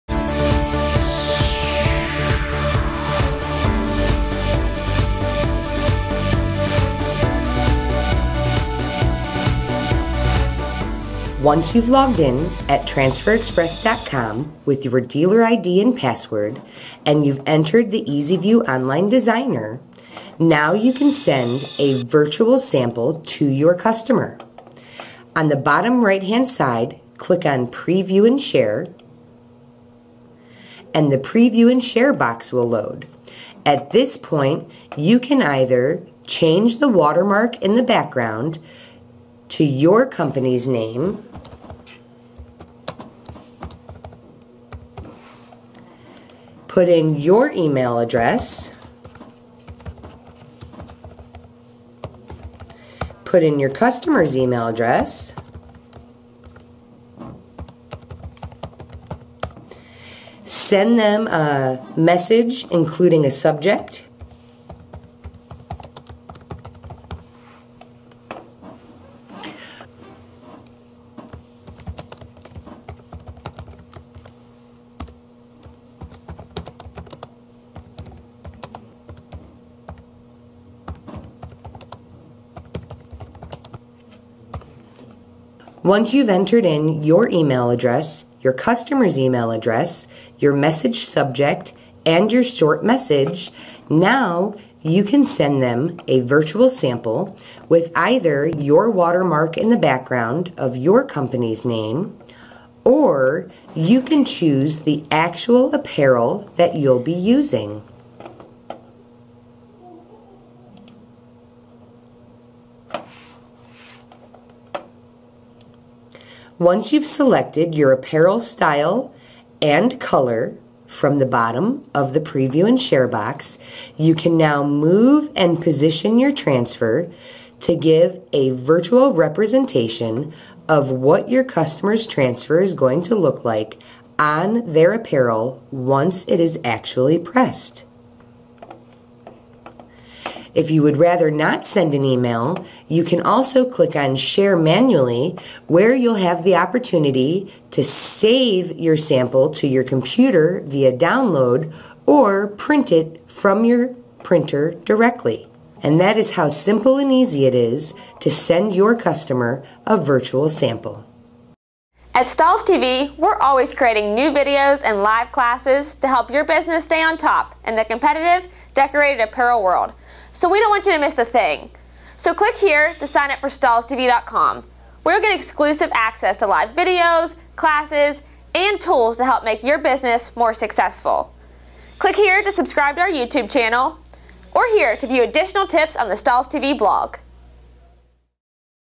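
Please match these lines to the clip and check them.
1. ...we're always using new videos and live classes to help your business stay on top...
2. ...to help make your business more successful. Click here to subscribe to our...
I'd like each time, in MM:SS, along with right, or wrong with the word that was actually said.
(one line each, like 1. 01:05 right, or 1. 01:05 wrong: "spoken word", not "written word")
1. 02:43 wrong: "creating", not "using"
2. 02:59 right.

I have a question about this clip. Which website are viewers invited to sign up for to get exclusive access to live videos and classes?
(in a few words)
StahlsTV.com.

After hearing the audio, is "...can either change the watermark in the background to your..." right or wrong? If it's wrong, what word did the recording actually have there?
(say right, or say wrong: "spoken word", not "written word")
right.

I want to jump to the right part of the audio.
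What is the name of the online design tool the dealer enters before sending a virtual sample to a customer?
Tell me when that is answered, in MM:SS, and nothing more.
00:18.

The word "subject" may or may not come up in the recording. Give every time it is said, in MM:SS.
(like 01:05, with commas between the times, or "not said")
01:03, 01:30.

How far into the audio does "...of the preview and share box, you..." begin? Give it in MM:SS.
02:01.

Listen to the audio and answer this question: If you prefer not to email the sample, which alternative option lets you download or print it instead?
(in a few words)
Share Manually.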